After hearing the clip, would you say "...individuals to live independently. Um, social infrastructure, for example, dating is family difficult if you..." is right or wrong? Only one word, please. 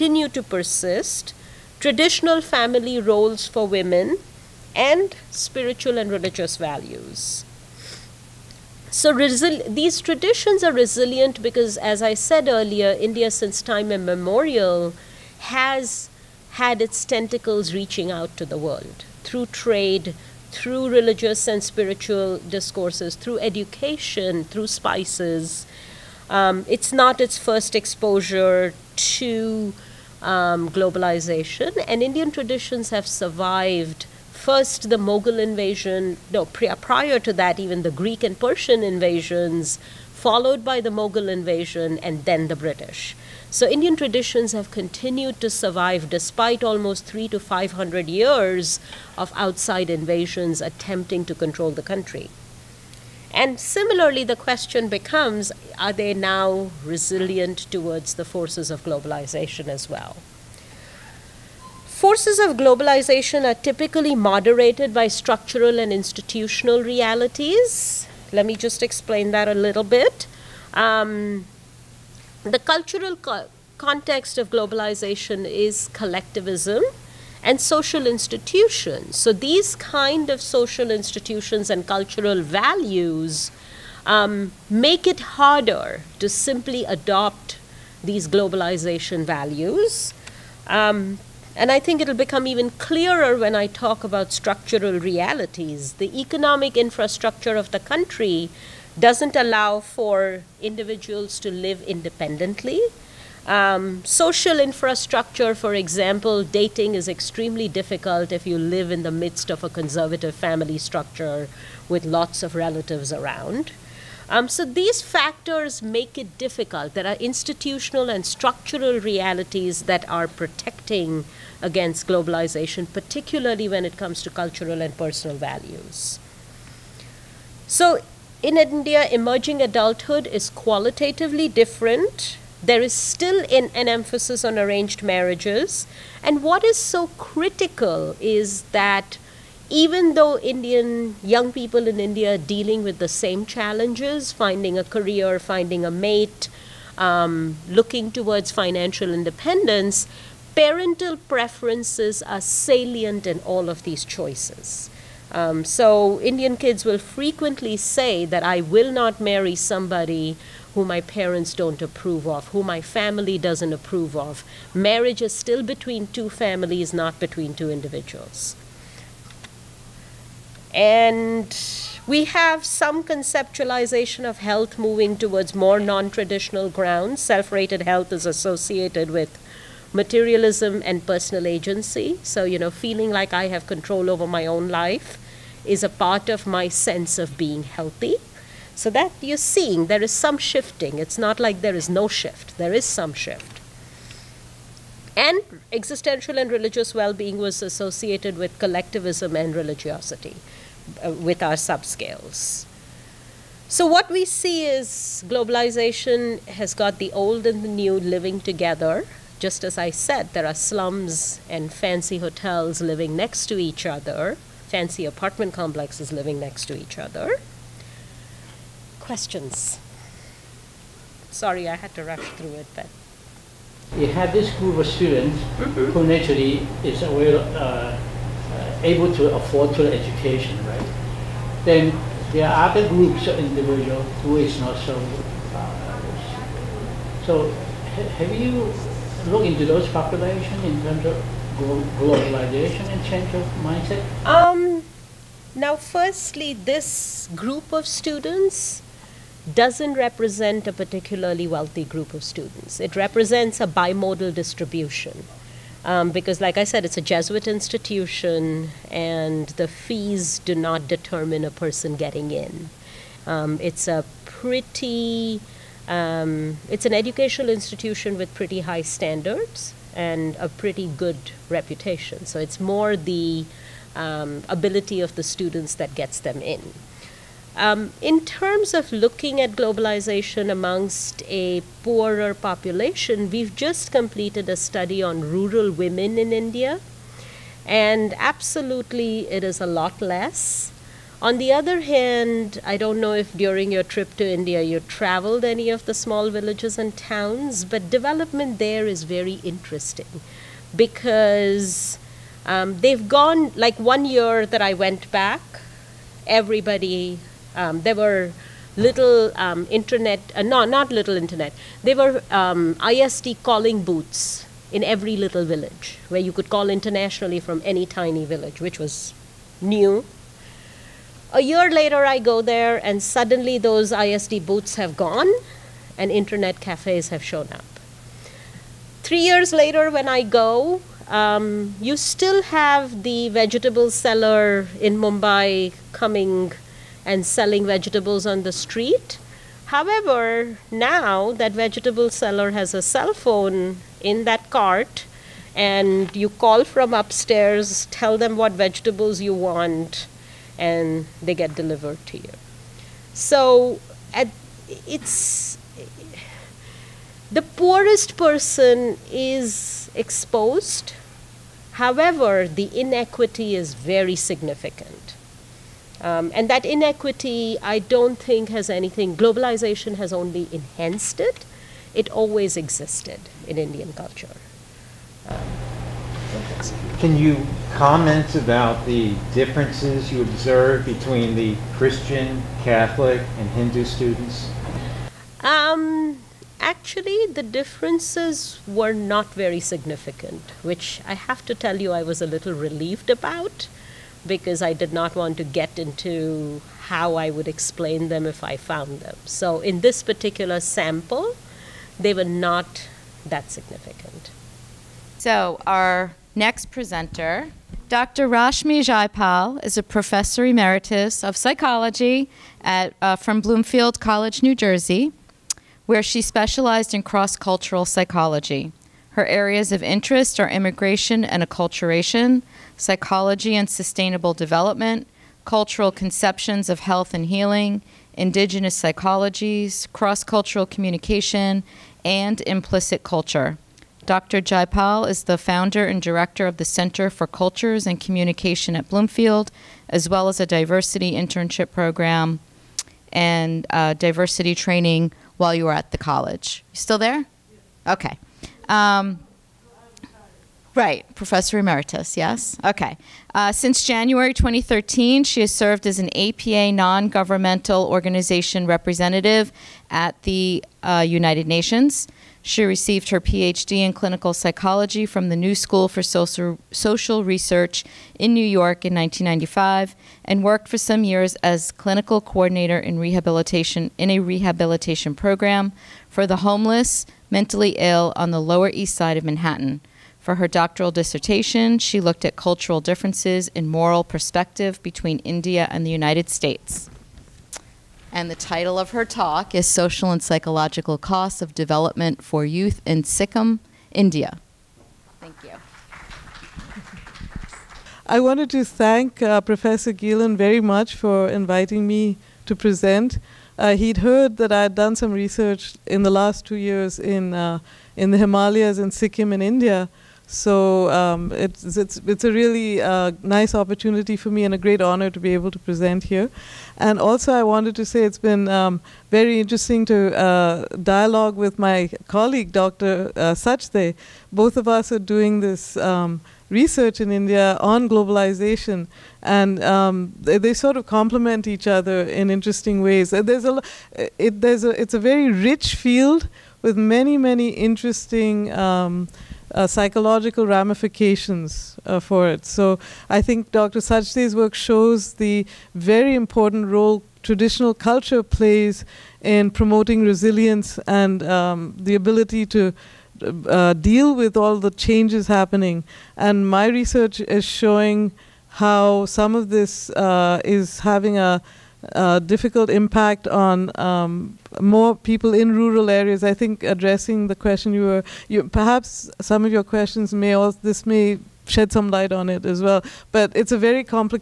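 wrong.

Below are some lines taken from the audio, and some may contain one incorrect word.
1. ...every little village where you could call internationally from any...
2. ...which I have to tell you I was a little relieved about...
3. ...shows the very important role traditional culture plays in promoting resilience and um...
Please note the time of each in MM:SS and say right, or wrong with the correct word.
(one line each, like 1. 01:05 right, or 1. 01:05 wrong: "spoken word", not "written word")
1. 05:14 right
2. 06:30 right
3. 09:04 right.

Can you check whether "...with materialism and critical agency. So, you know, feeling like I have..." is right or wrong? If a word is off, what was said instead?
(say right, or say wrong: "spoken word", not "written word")
wrong: "personal", not "critical".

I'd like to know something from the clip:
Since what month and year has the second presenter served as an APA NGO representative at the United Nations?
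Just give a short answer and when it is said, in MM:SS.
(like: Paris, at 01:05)
January 2013, at 07:33.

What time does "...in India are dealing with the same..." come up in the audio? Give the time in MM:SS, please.
02:21.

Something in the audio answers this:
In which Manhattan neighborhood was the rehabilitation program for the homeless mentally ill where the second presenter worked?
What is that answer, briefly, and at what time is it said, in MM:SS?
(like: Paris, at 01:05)
Lower East Side, at 07:58.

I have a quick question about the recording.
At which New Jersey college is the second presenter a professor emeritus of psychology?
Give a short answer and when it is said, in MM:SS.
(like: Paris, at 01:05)
Bloomfield College, at 06:53.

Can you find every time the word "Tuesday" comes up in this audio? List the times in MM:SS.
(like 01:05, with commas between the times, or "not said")
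not said.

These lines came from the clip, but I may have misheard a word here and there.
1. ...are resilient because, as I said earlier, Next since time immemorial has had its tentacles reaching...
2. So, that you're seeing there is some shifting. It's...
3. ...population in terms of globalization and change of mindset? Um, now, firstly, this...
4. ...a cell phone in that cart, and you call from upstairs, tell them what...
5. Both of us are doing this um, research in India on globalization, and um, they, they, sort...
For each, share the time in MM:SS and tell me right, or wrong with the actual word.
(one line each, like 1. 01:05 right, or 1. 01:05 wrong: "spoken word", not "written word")
1. 00:10 wrong: "India", not "Next"
2. 03:08 right
3. 03:59 right
4. 05:42 right
5. 08:44 right.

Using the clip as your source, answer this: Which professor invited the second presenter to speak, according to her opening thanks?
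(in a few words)
Professor Gielen.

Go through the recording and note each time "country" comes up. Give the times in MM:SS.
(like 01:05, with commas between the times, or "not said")
00:51, 01:37.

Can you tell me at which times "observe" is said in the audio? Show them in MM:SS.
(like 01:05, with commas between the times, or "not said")
06:20.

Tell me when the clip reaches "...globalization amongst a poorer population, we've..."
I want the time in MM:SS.
04:39.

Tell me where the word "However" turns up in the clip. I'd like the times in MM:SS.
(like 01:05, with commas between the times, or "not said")
05:39, 06:01.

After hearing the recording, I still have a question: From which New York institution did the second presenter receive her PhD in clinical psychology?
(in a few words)
New School for Social Research.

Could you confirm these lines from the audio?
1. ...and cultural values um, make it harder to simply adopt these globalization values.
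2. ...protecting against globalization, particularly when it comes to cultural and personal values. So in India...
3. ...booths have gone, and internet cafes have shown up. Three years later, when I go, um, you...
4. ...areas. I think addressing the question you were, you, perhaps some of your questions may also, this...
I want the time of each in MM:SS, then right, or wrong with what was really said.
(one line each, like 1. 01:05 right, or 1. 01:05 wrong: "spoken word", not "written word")
1. 01:21 right
2. 02:00 right
3. 05:24 right
4. 09:25 right.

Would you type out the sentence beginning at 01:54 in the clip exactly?
Um, so these factors make it difficult.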